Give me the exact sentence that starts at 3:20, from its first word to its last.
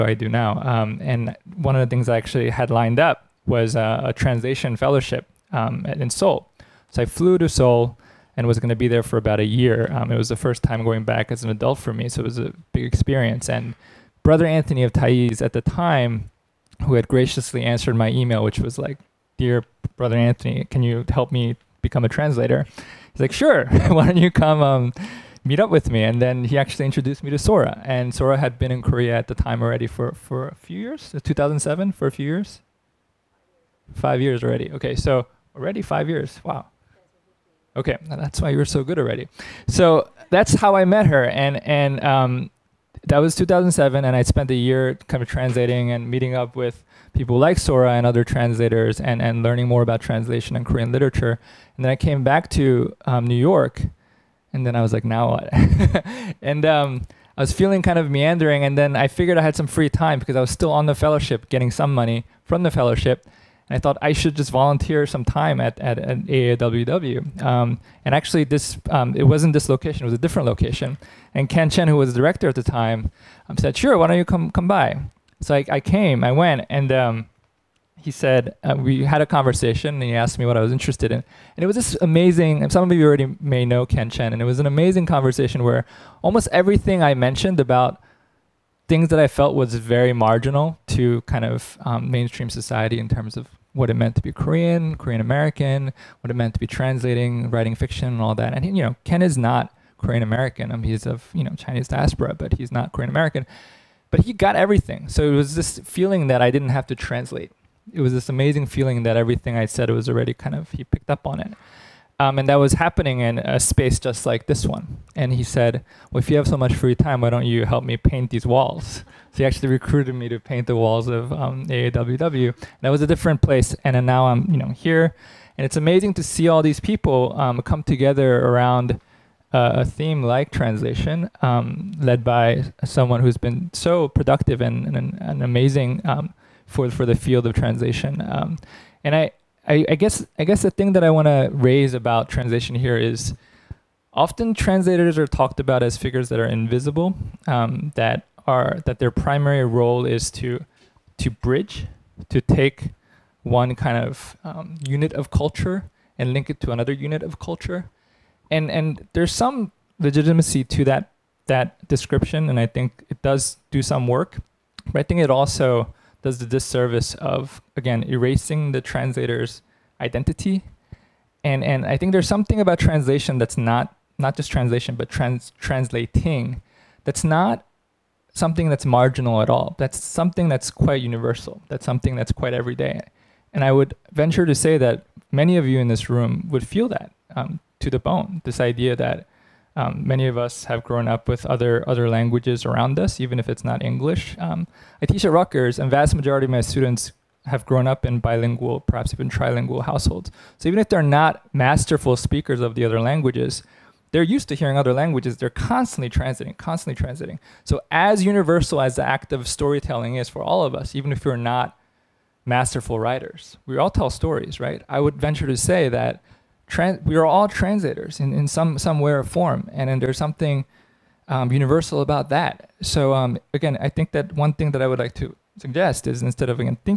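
So even if they're not masterful speakers of the other languages, they're used to hearing other languages.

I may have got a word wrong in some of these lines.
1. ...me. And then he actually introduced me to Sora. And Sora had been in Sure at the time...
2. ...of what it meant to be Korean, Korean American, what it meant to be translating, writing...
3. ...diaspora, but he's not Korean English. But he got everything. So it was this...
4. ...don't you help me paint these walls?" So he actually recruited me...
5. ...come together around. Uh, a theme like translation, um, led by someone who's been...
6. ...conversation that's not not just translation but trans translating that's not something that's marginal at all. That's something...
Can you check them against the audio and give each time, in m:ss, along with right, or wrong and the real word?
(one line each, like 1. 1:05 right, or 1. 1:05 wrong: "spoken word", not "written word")
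1. 0:25 wrong: "Korea", not "Sure"
2. 1:33 right
3. 1:41 wrong: "American", not "English"
4. 1:57 right
5. 2:07 right
6. 2:52 wrong: "translation", not "conversation".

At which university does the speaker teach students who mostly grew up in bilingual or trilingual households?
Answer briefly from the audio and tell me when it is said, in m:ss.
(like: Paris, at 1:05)
Rutgers, at 3:15.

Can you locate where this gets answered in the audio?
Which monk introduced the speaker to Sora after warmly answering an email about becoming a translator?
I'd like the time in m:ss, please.
0:14.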